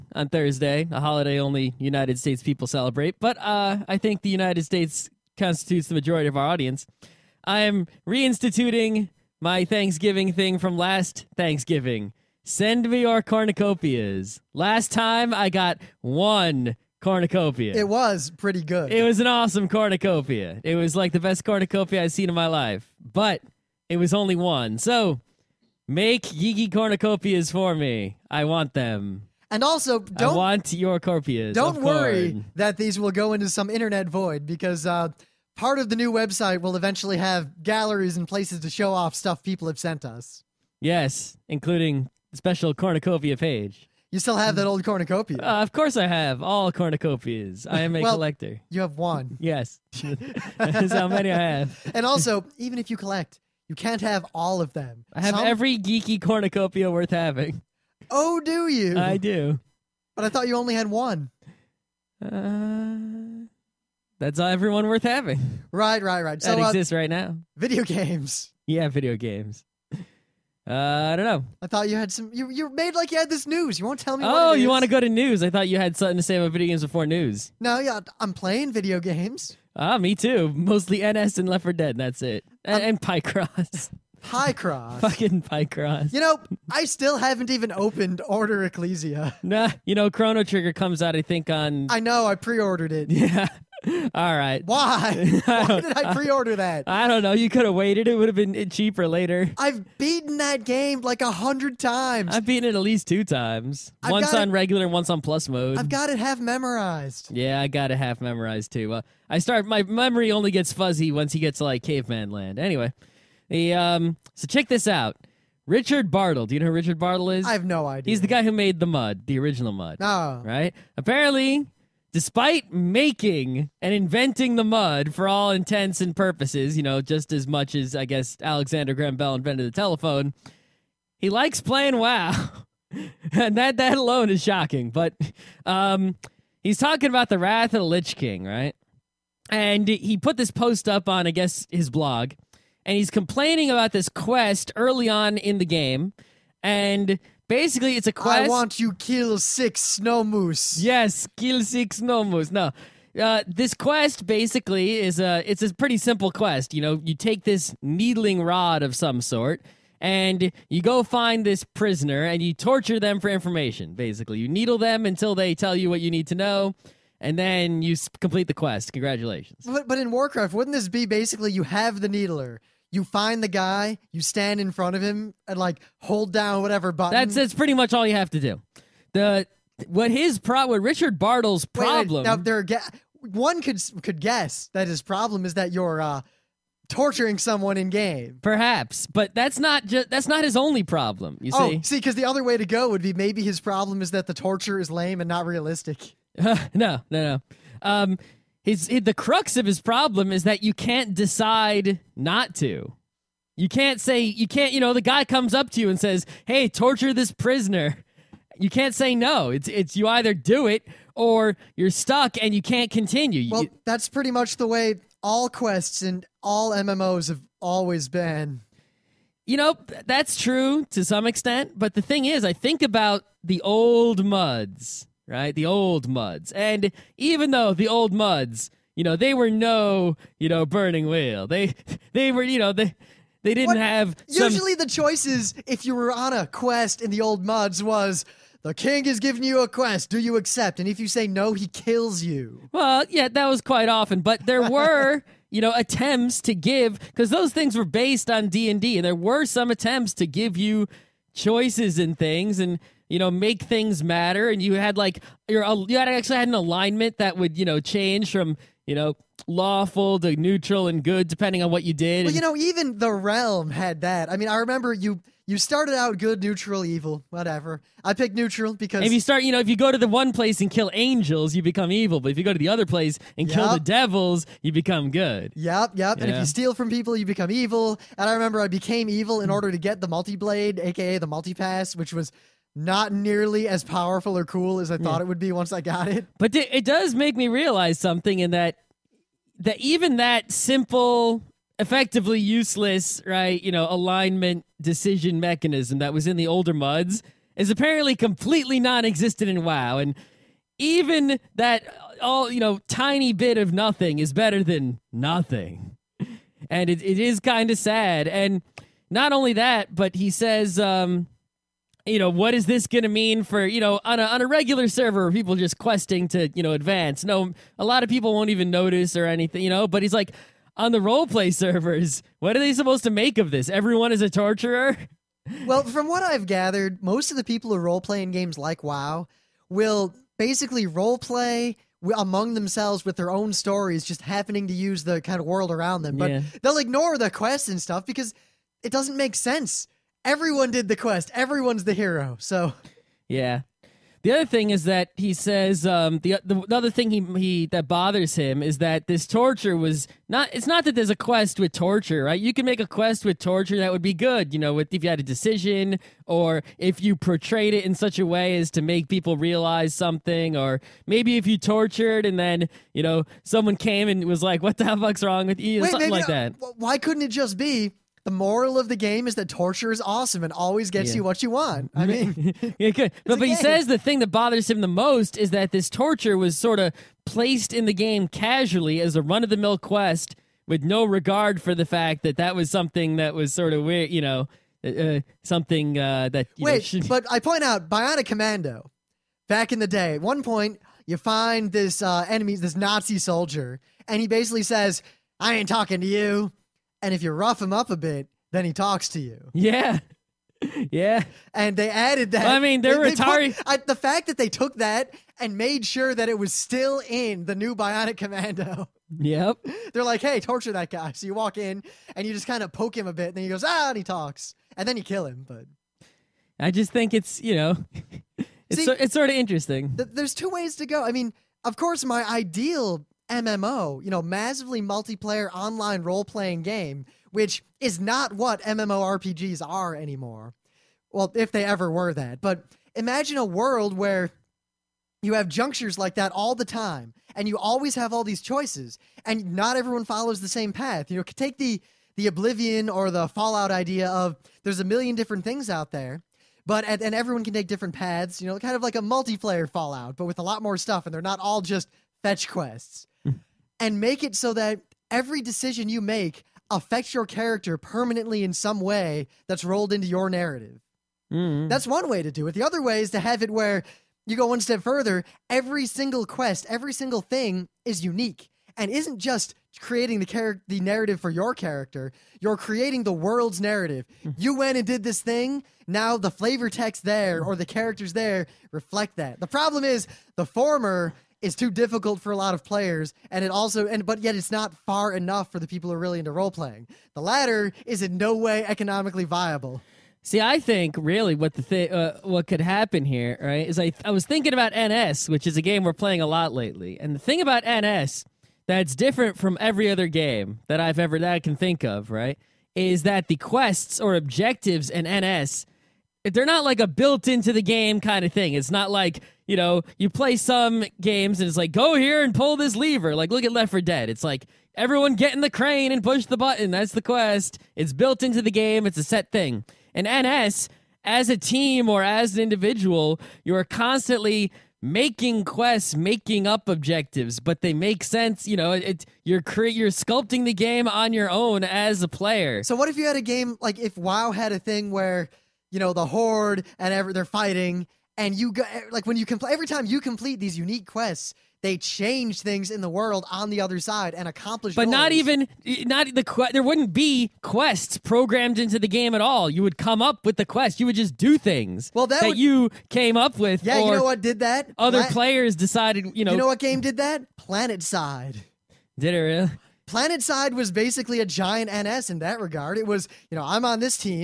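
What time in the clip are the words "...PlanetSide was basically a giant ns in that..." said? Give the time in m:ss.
9:19.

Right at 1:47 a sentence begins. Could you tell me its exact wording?
Yeah, I got it half memorized too.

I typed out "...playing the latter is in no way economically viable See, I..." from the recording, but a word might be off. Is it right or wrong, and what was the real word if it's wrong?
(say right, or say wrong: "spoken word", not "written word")
right.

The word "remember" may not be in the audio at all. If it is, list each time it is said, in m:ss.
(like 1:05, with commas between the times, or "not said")
4:24, 4:38.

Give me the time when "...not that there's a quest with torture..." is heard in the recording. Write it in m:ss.
5:50.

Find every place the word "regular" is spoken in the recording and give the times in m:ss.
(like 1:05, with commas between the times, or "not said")
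1:44, 5:14.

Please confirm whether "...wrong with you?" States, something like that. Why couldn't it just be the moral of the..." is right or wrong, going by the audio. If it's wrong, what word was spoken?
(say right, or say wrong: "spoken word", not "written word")
wrong: "Wait", not "States".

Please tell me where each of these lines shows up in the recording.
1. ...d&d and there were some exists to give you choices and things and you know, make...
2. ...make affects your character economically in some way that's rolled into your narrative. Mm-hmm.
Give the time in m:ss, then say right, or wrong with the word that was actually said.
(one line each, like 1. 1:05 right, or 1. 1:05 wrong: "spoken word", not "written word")
1. 4:08 wrong: "attempts", not "exists"
2. 7:35 wrong: "permanently", not "economically".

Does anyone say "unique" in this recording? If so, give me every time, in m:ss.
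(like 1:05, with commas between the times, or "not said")
7:48, 9:00.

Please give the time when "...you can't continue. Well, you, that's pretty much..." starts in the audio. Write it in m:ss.
3:32.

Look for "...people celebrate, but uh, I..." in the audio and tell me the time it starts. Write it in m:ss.
0:02.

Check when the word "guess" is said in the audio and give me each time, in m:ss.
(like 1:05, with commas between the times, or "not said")
2:08, 2:21, 3:04.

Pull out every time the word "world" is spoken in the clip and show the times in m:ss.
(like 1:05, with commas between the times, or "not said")
5:35, 7:13, 7:53, 9:02.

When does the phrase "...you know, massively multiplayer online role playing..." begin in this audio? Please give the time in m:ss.
7:04.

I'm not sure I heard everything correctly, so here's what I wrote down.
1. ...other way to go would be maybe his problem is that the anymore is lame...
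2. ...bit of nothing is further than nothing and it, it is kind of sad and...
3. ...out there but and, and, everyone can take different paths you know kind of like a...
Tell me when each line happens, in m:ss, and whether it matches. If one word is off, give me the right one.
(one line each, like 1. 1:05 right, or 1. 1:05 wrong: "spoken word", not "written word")
1. 3:12 wrong: "torture", not "anymore"
2. 5:03 wrong: "better", not "further"
3. 7:25 right.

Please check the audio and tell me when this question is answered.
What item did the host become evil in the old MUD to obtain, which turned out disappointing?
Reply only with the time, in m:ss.
4:40.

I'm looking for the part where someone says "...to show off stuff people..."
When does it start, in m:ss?
0:38.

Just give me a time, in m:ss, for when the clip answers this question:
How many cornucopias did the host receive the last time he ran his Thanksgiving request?
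0:15.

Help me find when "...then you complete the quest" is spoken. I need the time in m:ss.
2:47.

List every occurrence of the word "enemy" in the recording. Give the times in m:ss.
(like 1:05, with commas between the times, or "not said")
6:32.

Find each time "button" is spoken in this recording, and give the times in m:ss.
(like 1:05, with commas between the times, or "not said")
2:56, 8:36.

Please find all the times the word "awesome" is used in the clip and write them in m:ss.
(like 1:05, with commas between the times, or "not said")
0:19, 6:09.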